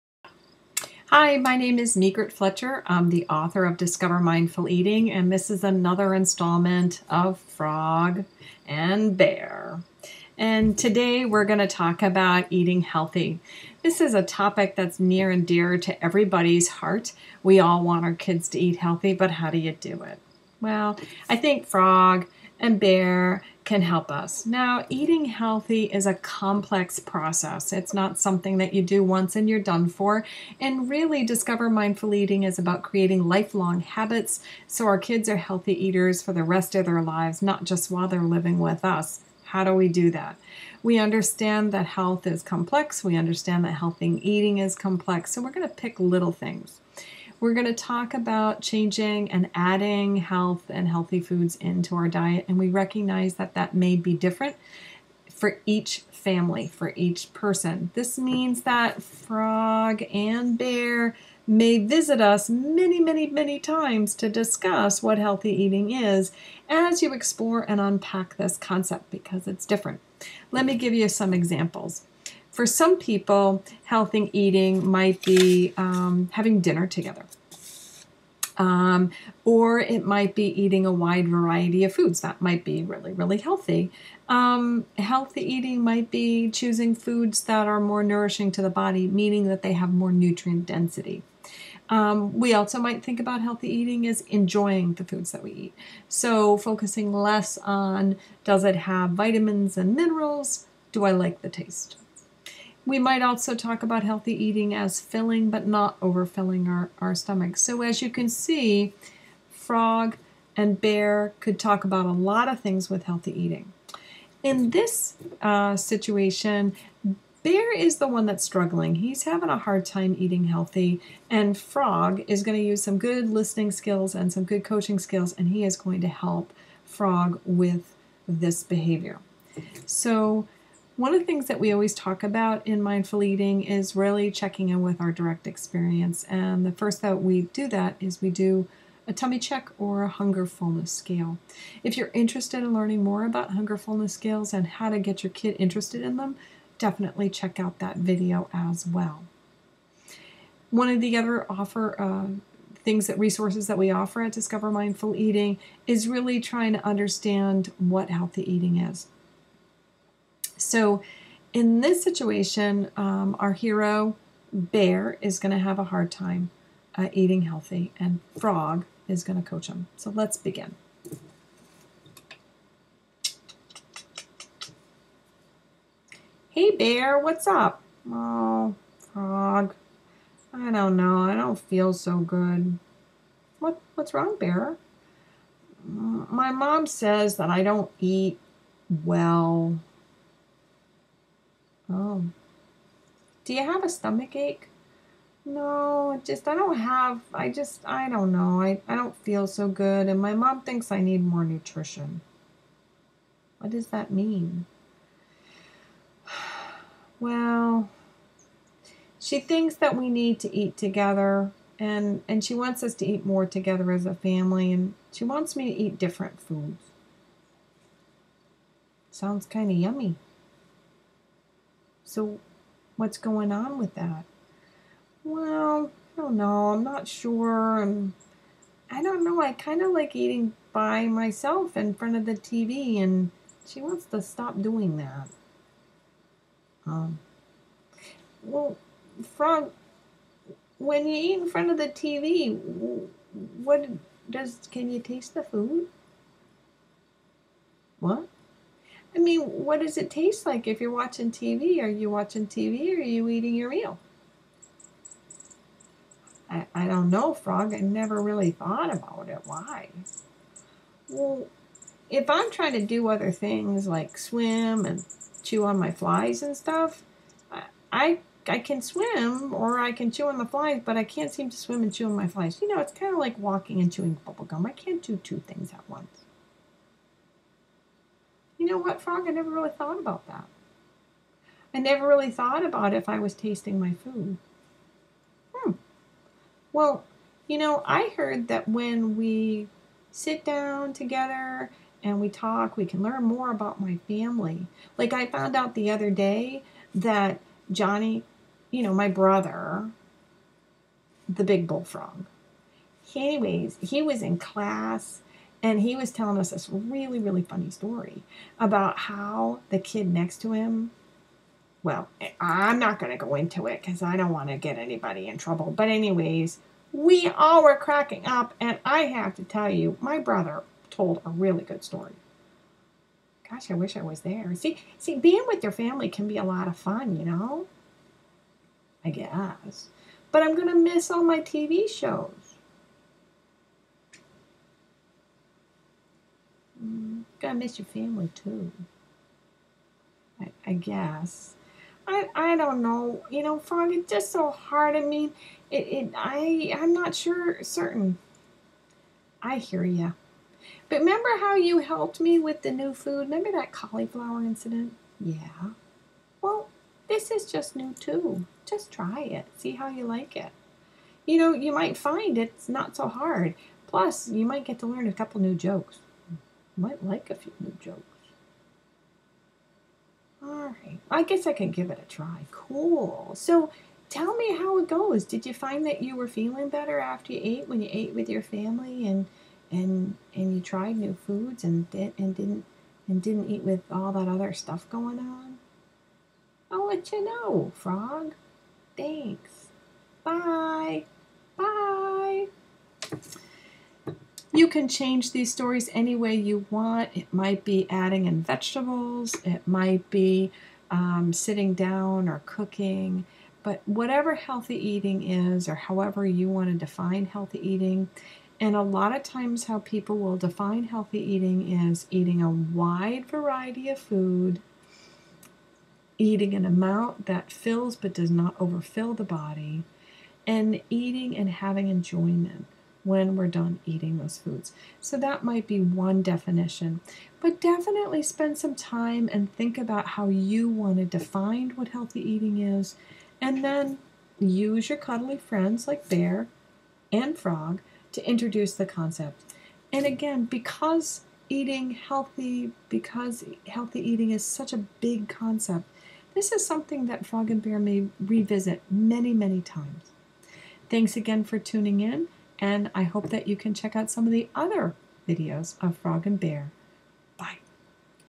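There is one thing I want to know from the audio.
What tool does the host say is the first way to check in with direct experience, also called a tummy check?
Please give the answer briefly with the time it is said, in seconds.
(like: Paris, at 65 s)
hunger fullness scale, at 140 s.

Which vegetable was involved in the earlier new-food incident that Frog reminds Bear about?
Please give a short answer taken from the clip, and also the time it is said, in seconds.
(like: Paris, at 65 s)
cauliflower, at 353 s.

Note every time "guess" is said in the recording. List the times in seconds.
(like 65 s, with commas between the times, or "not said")
329 s, 340 s, 371 s.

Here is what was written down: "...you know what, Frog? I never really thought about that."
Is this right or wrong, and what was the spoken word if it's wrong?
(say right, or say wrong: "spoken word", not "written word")
right.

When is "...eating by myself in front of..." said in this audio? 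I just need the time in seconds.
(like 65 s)
230 s.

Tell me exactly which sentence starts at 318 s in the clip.
And I have to tell you, my brother told a really good story.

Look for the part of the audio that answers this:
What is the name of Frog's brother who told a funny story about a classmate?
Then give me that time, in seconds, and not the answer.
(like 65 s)
297 s.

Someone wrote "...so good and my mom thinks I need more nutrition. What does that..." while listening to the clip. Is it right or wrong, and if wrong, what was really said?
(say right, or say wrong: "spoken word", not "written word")
right.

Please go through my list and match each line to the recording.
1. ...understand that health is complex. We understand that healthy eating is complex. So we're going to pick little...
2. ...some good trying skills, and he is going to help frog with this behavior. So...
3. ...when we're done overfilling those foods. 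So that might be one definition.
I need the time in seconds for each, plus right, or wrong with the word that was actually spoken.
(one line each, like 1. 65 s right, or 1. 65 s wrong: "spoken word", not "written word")
1. 40 s right
2. 124 s wrong: "coaching", not "trying"
3. 423 s wrong: "eating", not "overfilling".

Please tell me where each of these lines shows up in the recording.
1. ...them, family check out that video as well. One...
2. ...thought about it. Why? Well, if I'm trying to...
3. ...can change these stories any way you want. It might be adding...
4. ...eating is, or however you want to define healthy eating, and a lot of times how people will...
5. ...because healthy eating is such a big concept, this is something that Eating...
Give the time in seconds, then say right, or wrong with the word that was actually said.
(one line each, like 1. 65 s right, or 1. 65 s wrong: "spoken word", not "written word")
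1. 146 s wrong: "definitely", not "family"
2. 258 s right
3. 394 s right
4. 404 s right
5. 442 s wrong: "Frog", not "Eating".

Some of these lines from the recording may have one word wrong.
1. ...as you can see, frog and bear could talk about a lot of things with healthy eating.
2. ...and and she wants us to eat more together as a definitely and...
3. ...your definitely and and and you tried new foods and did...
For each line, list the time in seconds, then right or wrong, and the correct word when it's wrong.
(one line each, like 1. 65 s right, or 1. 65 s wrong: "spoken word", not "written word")
1. 107 s right
2. 211 s wrong: "family", not "definitely"
3. 378 s wrong: "family", not "definitely".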